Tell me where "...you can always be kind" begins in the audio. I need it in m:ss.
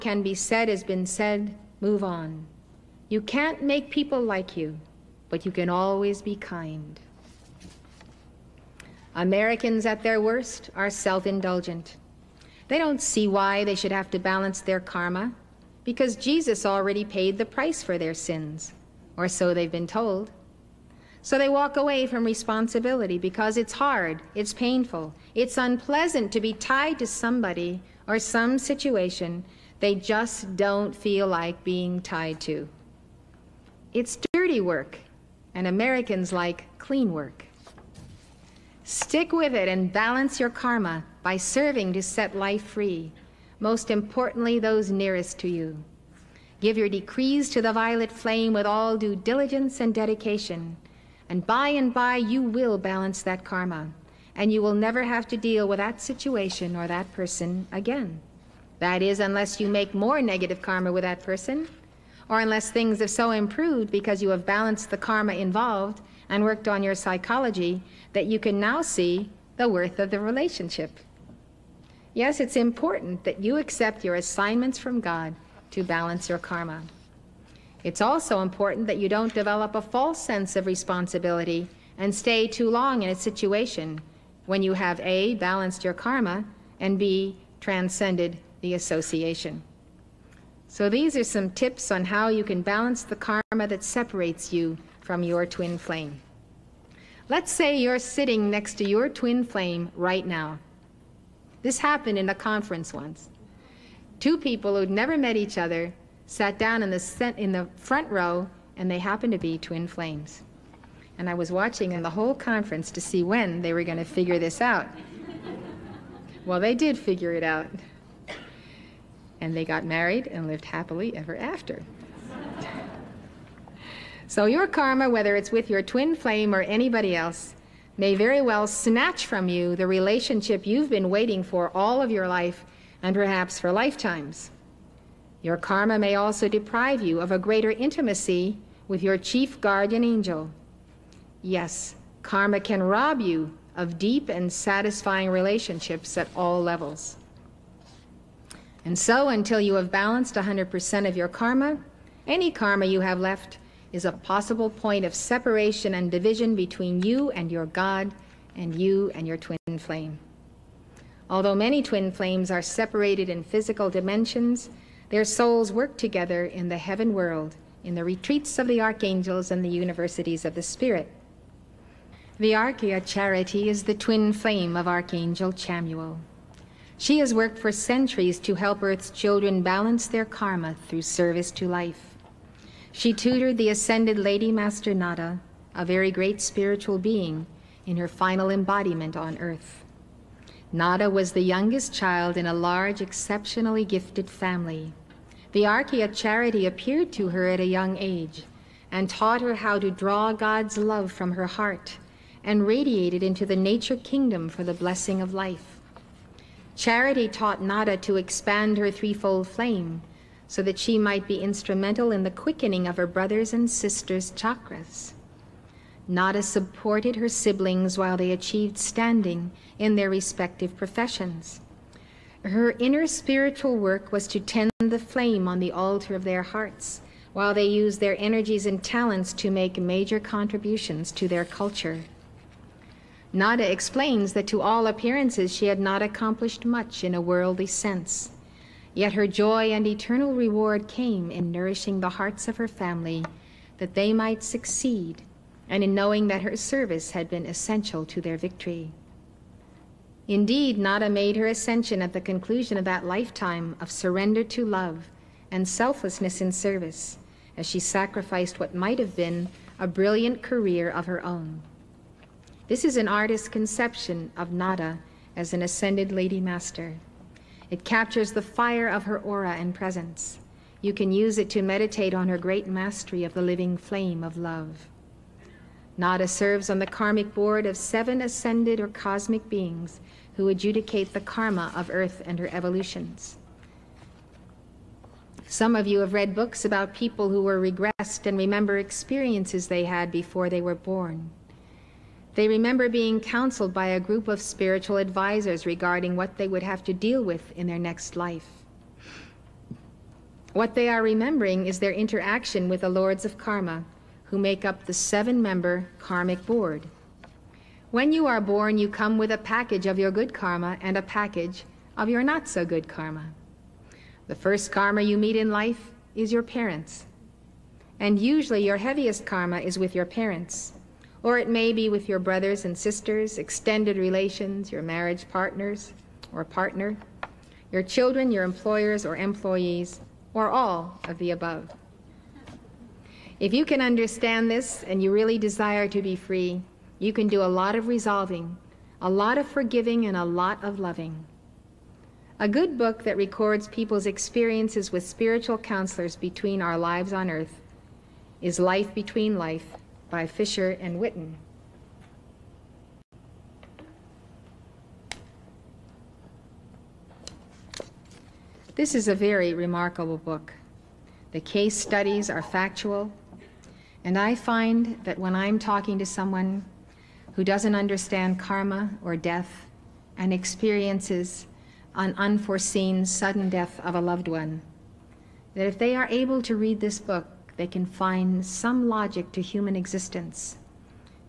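0:05.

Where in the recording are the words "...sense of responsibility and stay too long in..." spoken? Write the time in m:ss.
1:20.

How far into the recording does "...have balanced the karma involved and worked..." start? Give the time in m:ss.
1:04.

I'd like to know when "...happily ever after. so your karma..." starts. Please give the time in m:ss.
2:00.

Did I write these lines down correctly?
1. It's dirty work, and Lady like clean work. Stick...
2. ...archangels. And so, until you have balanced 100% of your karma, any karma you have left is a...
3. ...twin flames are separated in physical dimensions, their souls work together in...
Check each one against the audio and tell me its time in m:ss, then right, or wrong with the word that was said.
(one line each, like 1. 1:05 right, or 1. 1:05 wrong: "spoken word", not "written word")
1. 0:33 wrong: "Americans", not "Lady"
2. 2:26 wrong: "levels", not "archangels"
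3. 2:41 right.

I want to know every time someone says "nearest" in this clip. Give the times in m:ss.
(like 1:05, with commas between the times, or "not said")
0:44.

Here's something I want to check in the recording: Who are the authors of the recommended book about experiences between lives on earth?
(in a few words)
Fisher and Whitton.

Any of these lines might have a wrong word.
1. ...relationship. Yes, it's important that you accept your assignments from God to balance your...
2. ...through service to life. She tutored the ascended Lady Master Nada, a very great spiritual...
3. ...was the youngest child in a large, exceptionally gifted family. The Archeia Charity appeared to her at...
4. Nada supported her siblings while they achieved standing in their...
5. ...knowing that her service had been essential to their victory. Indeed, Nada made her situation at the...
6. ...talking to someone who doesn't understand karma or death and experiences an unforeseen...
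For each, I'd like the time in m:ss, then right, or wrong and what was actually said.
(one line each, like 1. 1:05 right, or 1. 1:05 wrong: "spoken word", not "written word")
1. 1:10 right
2. 3:00 right
3. 3:11 right
4. 3:36 right
5. 4:05 wrong: "ascension", not "situation"
6. 6:05 right.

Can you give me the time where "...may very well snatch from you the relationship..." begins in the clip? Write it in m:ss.
2:07.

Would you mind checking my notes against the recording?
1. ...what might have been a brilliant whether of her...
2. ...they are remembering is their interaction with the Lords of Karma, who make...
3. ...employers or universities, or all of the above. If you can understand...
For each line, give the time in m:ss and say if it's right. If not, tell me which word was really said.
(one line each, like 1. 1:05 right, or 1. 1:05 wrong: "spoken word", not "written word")
1. 4:18 wrong: "career", not "whether"
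2. 5:00 right
3. 5:28 wrong: "employees", not "universities".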